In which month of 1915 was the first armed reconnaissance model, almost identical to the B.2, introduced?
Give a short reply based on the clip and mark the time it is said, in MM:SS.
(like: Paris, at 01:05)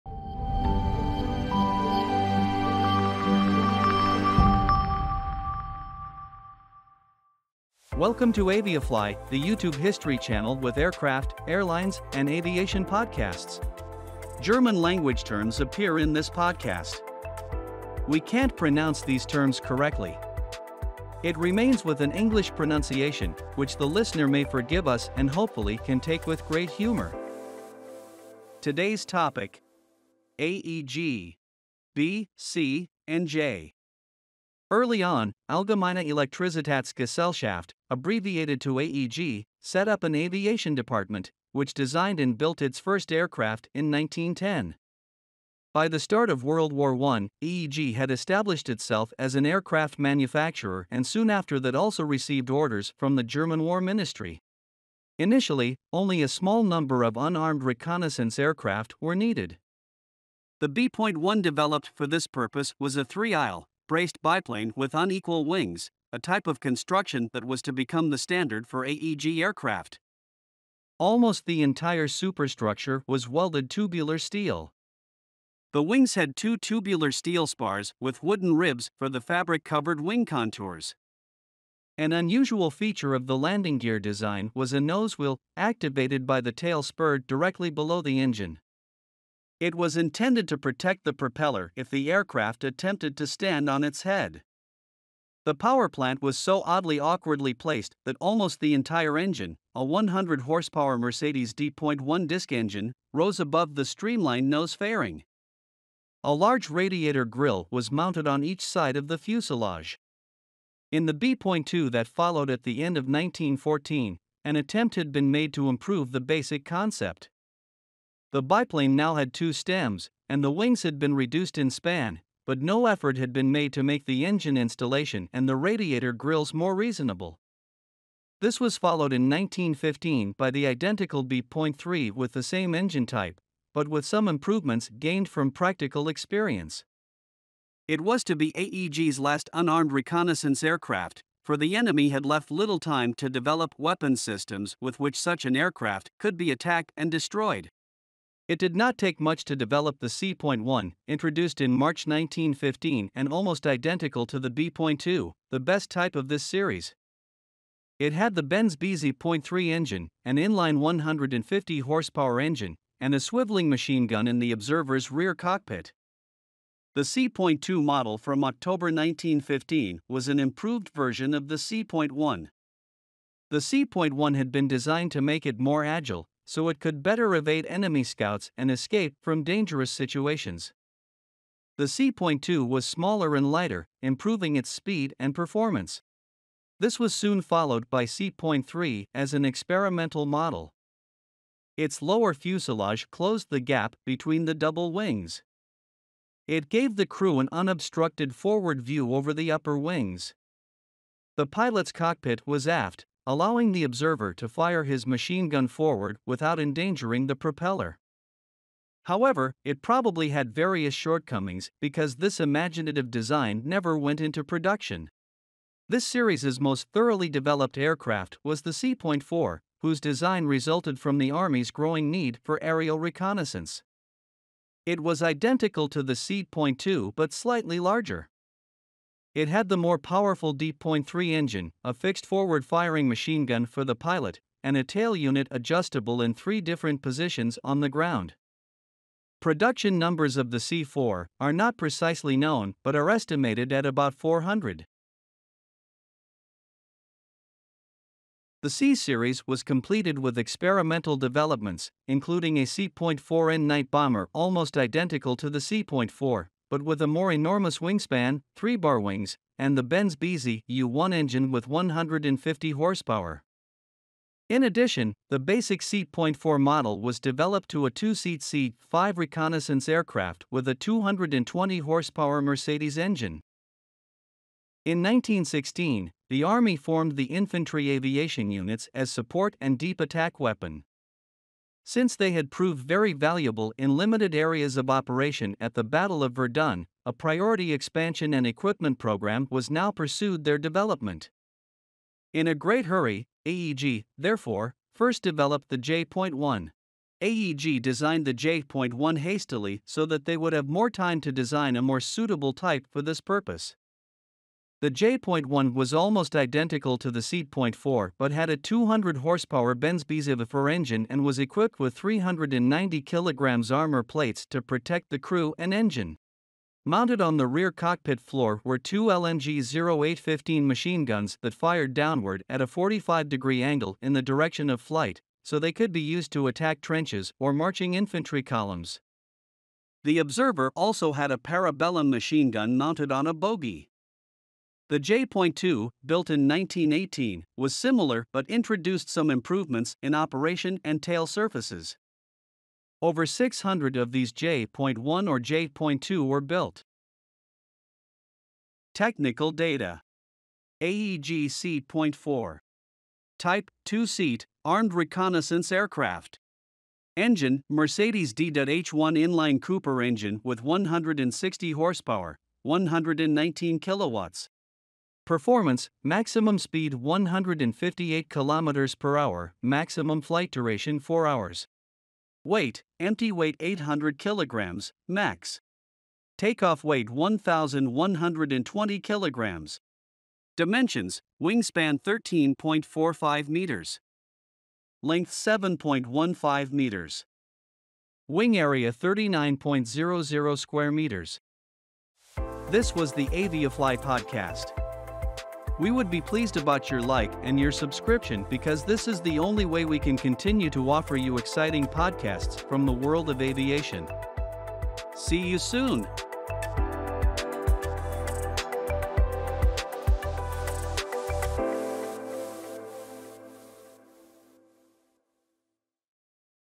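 March, at 02:31.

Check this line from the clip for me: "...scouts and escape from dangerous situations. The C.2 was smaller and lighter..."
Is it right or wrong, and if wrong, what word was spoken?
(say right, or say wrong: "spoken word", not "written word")
right.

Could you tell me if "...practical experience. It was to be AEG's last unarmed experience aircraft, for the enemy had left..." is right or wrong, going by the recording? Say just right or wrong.
wrong.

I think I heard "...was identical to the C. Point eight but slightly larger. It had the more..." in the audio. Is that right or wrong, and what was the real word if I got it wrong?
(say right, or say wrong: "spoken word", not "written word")
wrong: "two", not "eight".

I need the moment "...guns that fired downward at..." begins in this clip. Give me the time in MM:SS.
05:21.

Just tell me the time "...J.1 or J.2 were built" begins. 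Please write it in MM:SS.
05:44.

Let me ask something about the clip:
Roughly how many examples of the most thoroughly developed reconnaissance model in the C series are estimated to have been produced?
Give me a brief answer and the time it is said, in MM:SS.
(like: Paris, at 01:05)
400, at 04:03.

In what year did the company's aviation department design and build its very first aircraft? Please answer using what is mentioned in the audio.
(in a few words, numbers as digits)
1910.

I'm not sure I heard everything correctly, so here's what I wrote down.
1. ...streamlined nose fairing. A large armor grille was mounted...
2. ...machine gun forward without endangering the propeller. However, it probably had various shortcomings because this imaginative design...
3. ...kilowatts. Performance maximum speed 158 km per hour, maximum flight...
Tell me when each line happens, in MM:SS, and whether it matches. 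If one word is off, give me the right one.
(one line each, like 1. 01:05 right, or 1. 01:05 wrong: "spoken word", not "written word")
1. 01:43 wrong: "radiator", not "armor"
2. 03:25 right
3. 06:03 right.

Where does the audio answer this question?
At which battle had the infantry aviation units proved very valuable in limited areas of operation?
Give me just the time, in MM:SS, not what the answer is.
04:45.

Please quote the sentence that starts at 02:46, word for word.
The C.2 model from October 1915 was an improved version of the C.1.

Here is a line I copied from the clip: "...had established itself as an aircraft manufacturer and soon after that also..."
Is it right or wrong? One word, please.
right.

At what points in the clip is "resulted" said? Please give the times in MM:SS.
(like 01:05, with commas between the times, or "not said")
03:40.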